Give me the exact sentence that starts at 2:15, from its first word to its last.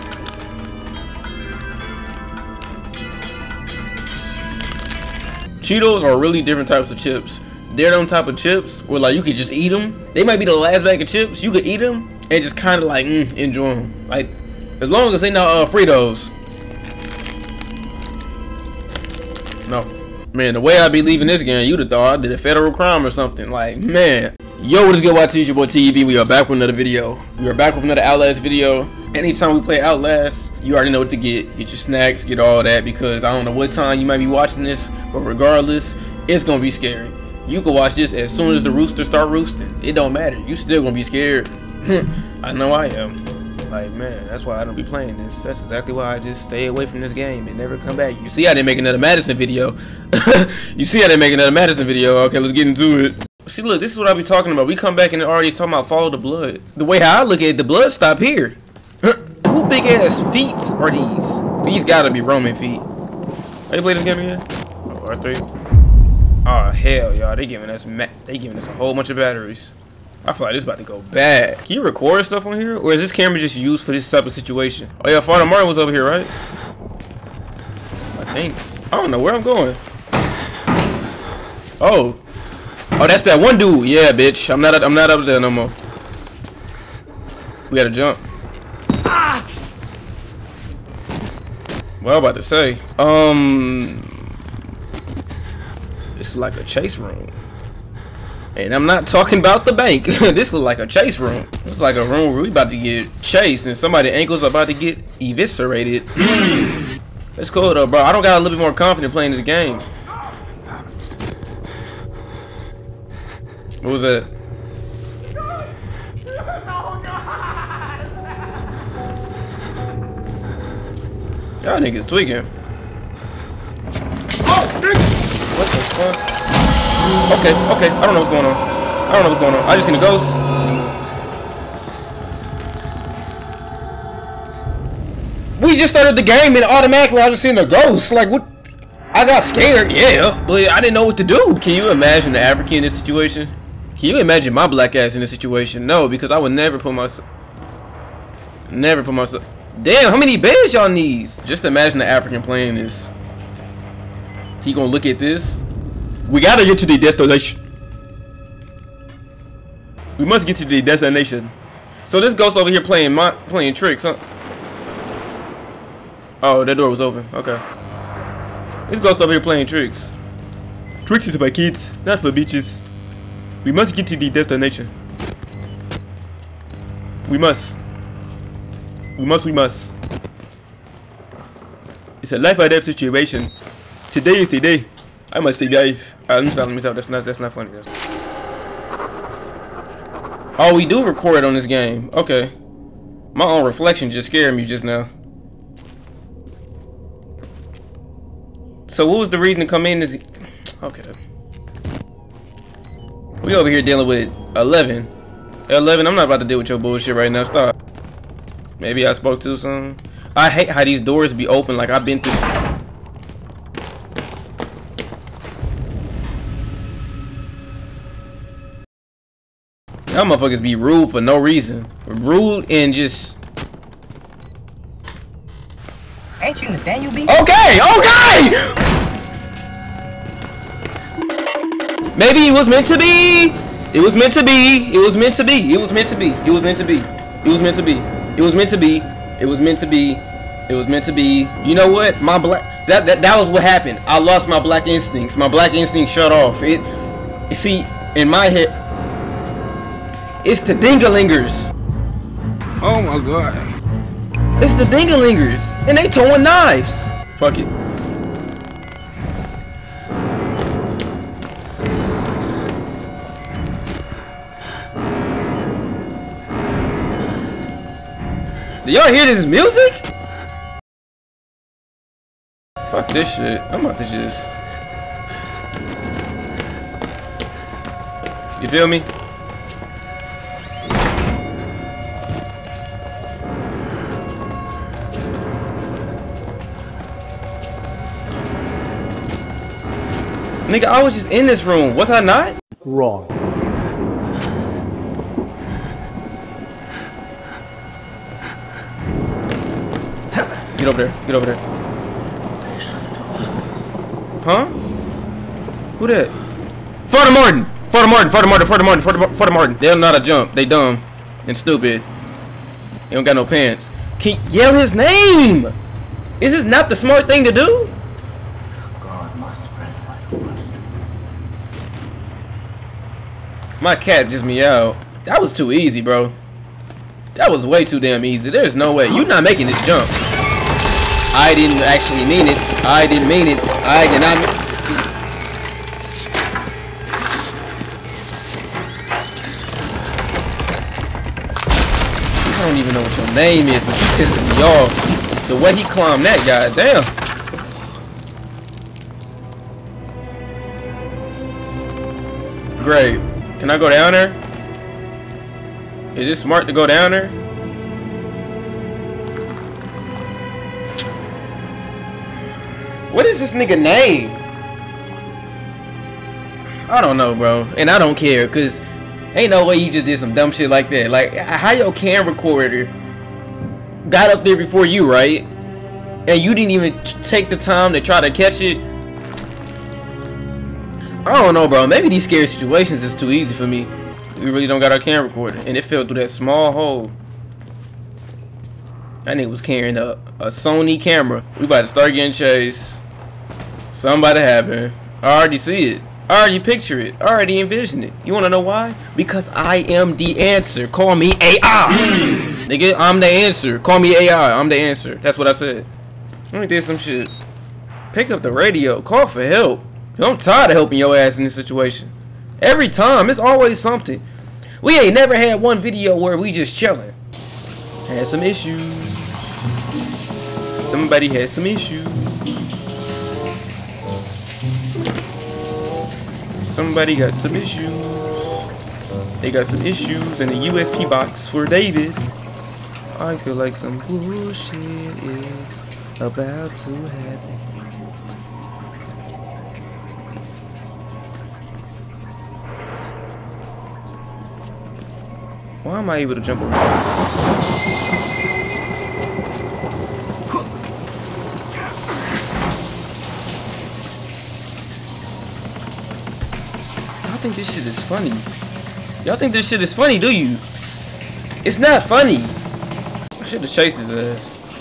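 We just started the game and automatically I just seen a ghost.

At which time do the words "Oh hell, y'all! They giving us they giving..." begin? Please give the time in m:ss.
1:06.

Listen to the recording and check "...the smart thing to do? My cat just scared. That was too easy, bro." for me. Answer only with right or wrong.
wrong.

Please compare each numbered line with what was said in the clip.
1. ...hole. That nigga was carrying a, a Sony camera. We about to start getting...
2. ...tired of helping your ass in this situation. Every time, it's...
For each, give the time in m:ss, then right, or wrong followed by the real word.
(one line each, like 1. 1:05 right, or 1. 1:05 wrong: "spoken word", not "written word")
1. 6:26 right
2. 6:50 right.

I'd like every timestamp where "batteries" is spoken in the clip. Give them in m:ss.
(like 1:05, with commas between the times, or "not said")
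1:09.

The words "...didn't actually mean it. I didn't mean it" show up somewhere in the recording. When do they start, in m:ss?
5:31.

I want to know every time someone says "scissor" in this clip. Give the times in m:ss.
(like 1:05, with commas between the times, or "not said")
not said.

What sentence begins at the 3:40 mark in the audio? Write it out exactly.
Y'all motherfuckers be rude for no reason.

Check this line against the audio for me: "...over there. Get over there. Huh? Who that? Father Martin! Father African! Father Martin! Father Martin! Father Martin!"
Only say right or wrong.
wrong.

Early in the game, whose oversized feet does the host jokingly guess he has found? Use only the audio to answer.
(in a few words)
Roman.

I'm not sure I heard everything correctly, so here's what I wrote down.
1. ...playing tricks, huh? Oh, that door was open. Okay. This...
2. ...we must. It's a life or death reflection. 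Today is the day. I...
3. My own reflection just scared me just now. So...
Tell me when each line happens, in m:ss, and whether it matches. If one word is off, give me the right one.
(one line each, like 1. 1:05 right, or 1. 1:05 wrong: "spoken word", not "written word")
1. 2:43 right
2. 2:59 wrong: "situation", not "reflection"
3. 3:13 right.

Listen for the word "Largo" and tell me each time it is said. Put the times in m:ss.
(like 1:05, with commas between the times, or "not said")
not said.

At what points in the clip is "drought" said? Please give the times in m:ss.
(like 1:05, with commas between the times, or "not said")
not said.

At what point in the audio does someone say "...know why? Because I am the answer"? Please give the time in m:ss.
6:38.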